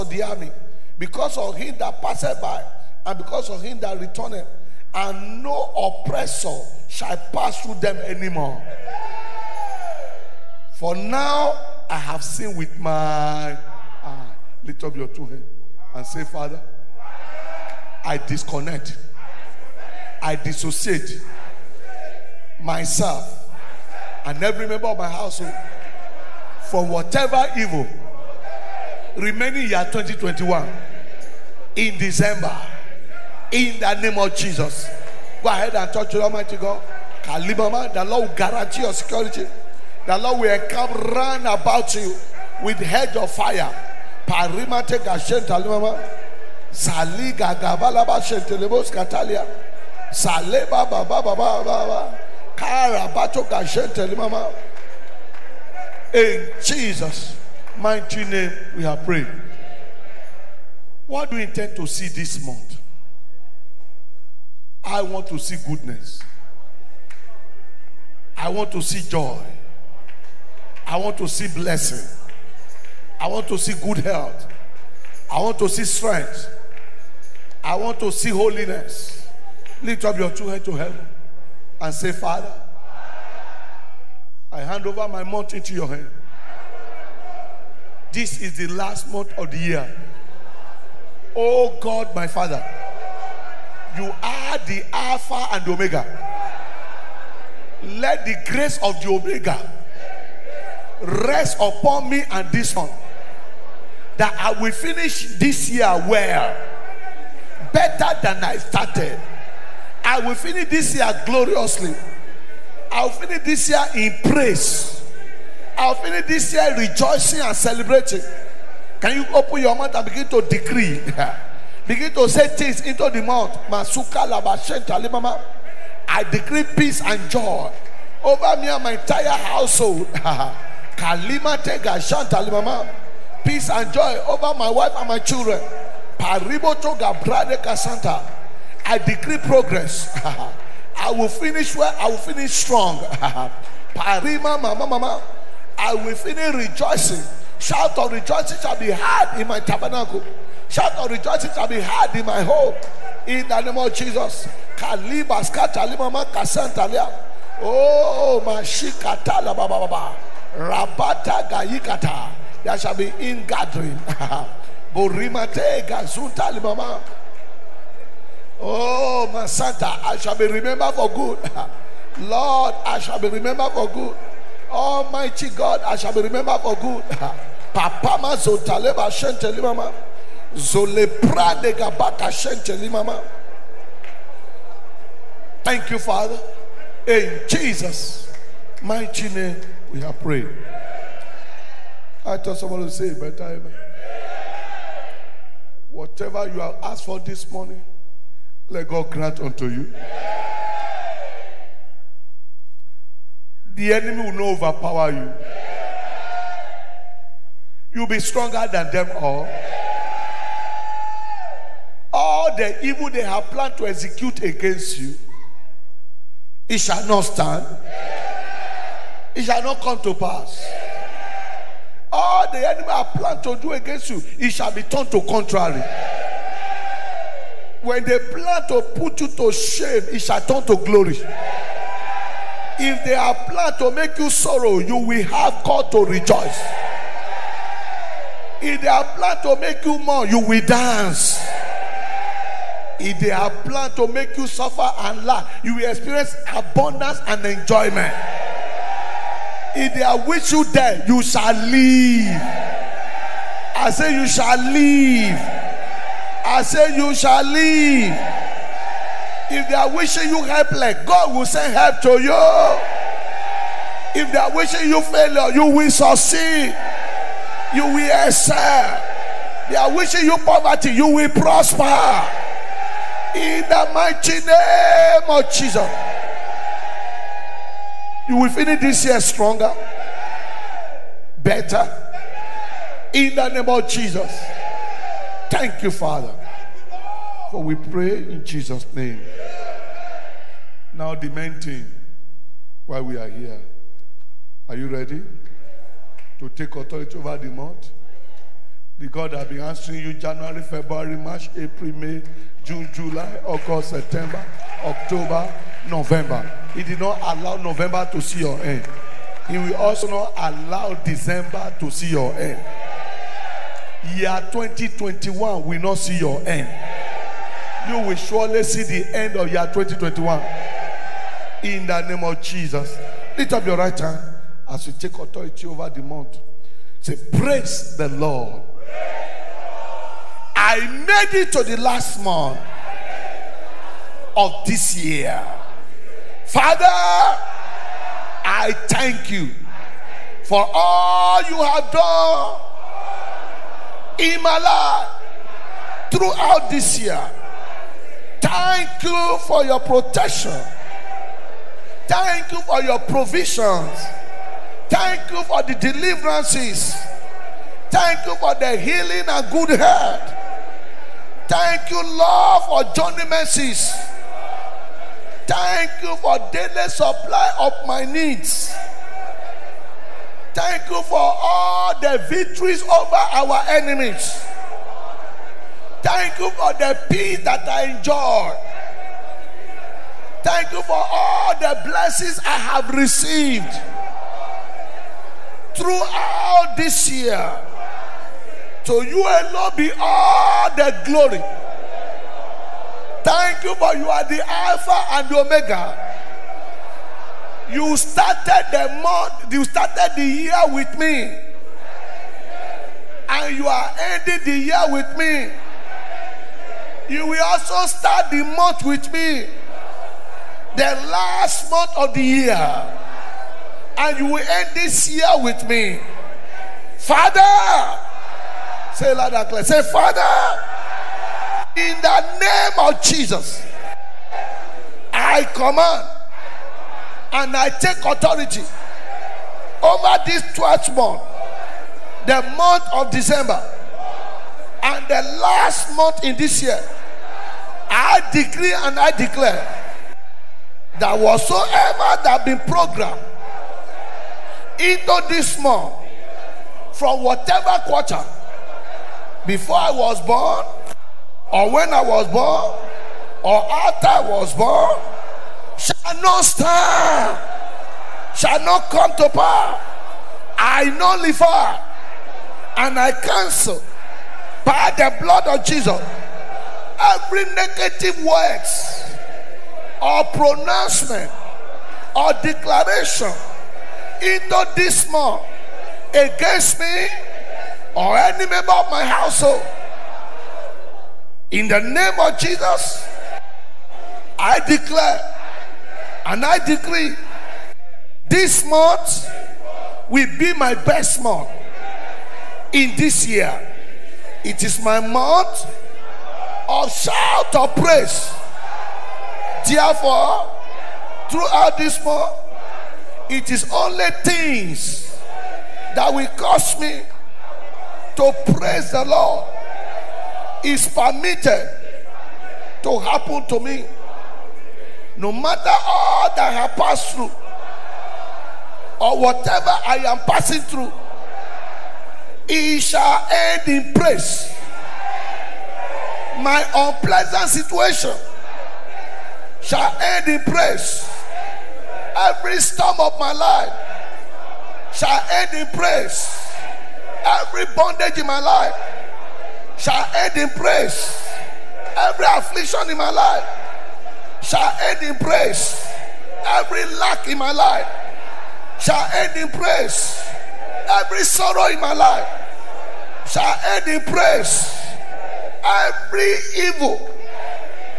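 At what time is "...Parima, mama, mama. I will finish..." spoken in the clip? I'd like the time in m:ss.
2:23.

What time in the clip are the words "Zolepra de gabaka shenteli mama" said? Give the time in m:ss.
3:00.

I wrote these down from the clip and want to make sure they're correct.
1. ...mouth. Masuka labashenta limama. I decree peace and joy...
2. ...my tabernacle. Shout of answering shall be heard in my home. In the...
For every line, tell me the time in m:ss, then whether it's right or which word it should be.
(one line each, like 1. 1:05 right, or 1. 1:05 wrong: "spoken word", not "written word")
1. 2:03 right
2. 2:29 wrong: "rejoicing", not "answering".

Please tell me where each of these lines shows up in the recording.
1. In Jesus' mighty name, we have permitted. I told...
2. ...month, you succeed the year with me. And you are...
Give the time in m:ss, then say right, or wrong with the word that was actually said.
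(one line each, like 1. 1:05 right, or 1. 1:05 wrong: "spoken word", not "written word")
1. 3:07 wrong: "prayed", not "permitted"
2. 6:39 wrong: "started", not "succeed".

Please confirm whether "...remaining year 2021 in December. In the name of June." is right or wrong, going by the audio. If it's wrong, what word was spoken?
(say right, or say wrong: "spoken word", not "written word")
wrong: "Jesus", not "June".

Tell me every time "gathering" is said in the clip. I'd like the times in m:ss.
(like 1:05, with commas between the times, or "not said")
2:43.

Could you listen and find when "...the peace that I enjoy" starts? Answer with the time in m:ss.
6:16.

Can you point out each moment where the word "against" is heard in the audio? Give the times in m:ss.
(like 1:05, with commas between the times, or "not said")
3:34, 3:43, 7:56.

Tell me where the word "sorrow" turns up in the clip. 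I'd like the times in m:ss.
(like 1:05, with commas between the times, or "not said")
3:54, 9:11.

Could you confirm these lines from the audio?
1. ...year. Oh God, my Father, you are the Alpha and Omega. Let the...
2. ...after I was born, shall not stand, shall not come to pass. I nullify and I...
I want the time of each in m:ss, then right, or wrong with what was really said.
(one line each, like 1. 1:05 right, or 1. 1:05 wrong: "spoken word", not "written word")
1. 1:29 right
2. 7:33 right.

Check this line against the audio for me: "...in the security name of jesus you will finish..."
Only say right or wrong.
wrong.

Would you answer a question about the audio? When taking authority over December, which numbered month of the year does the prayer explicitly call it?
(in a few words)
12th month.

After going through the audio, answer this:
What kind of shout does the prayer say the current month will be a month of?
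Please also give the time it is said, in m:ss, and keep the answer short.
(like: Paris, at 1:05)
shout of praise, at 8:16.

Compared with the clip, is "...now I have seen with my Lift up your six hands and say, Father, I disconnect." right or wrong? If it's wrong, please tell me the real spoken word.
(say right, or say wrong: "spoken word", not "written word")
wrong: "two", not "six".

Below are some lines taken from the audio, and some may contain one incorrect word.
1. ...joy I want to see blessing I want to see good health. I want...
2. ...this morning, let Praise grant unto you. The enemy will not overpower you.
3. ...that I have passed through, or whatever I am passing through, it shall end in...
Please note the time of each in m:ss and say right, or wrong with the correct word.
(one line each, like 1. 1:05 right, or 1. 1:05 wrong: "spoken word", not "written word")
1. 1:09 right
2. 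3:17 wrong: "God", not "Praise"
3. 8:36 right.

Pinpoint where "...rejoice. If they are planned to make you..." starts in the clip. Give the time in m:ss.
3:56.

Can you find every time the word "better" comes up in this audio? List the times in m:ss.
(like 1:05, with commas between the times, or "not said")
1:47, 3:13, 4:41.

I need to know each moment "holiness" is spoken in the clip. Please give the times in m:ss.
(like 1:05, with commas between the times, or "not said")
1:18.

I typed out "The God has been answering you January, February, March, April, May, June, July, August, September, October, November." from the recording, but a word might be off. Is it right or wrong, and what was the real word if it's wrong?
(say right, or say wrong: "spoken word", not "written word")
right.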